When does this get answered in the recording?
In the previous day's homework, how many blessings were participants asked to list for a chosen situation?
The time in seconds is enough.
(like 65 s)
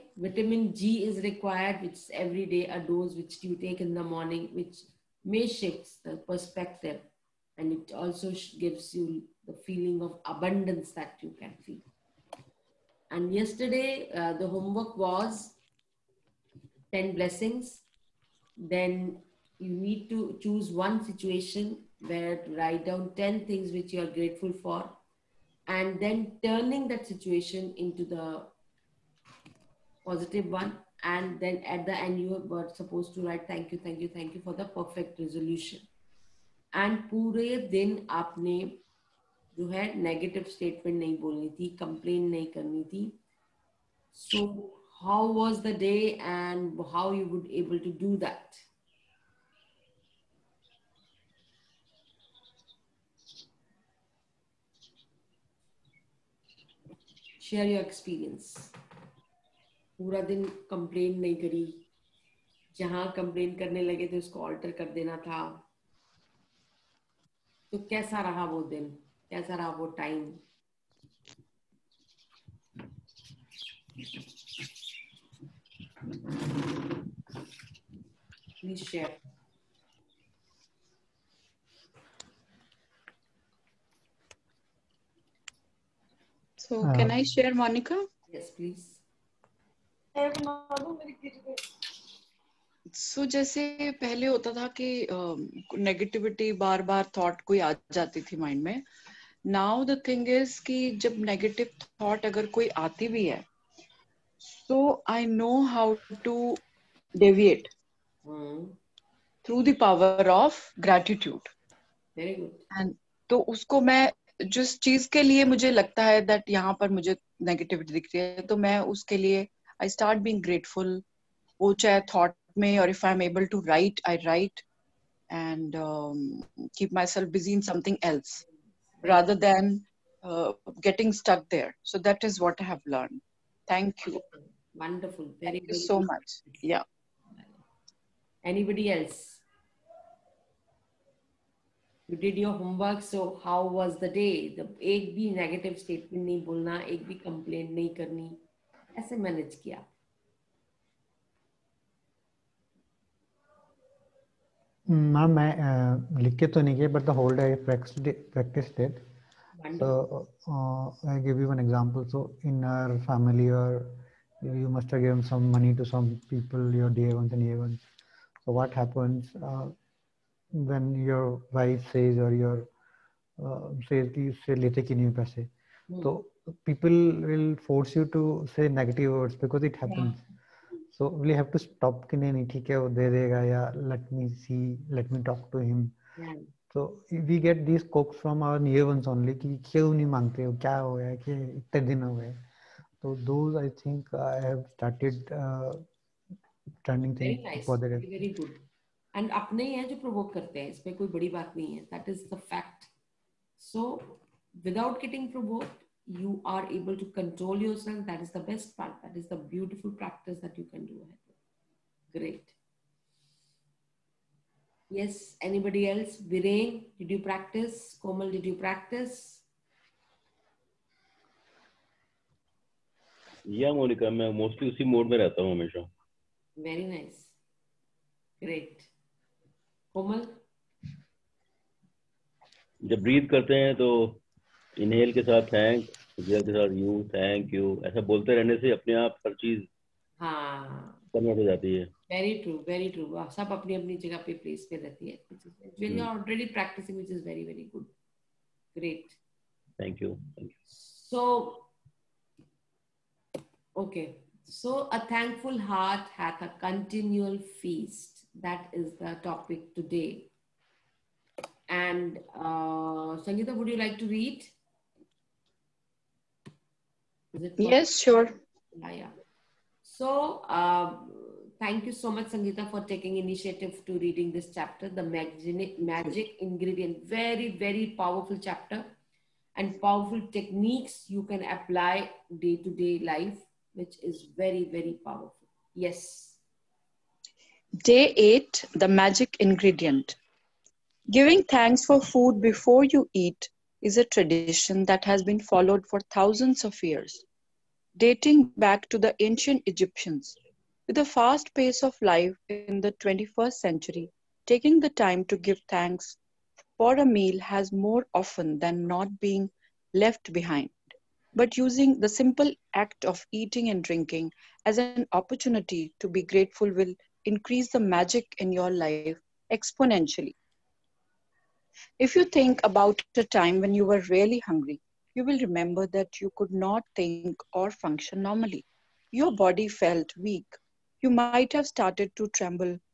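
16 s.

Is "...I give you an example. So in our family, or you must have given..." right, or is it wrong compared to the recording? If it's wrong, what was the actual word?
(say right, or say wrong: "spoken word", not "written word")
right.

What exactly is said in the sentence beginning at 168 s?
So what happens uh, when your wife says or your uh, says कि इससे लेते क्यों नहीं पैसे?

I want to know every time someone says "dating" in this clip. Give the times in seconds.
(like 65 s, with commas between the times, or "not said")
297 s.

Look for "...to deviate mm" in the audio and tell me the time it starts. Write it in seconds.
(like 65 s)
106 s.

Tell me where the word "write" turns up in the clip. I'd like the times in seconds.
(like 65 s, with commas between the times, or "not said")
22 s, 33 s.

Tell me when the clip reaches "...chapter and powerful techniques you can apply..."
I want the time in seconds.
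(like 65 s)
278 s.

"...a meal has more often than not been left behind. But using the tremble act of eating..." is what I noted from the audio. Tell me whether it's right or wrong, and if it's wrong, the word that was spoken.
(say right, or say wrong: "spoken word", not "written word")
wrong: "simple", not "tremble".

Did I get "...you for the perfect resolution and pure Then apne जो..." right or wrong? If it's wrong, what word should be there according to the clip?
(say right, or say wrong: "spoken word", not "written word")
right.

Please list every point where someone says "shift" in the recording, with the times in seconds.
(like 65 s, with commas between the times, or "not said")
5 s.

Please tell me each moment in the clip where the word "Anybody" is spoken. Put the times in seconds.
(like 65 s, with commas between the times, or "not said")
138 s, 215 s.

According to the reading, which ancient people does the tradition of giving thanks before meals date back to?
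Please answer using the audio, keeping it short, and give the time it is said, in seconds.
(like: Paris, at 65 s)
The ancient Egyptians, at 299 s.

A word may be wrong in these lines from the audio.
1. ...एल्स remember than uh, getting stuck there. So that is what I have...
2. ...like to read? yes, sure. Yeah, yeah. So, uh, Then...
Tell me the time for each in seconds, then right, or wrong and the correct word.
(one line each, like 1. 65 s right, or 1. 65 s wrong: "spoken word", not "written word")
1. 128 s wrong: "rather", not "remember"
2. 263 s wrong: "Thank", not "Then".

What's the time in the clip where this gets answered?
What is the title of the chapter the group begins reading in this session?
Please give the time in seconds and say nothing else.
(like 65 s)
288 s.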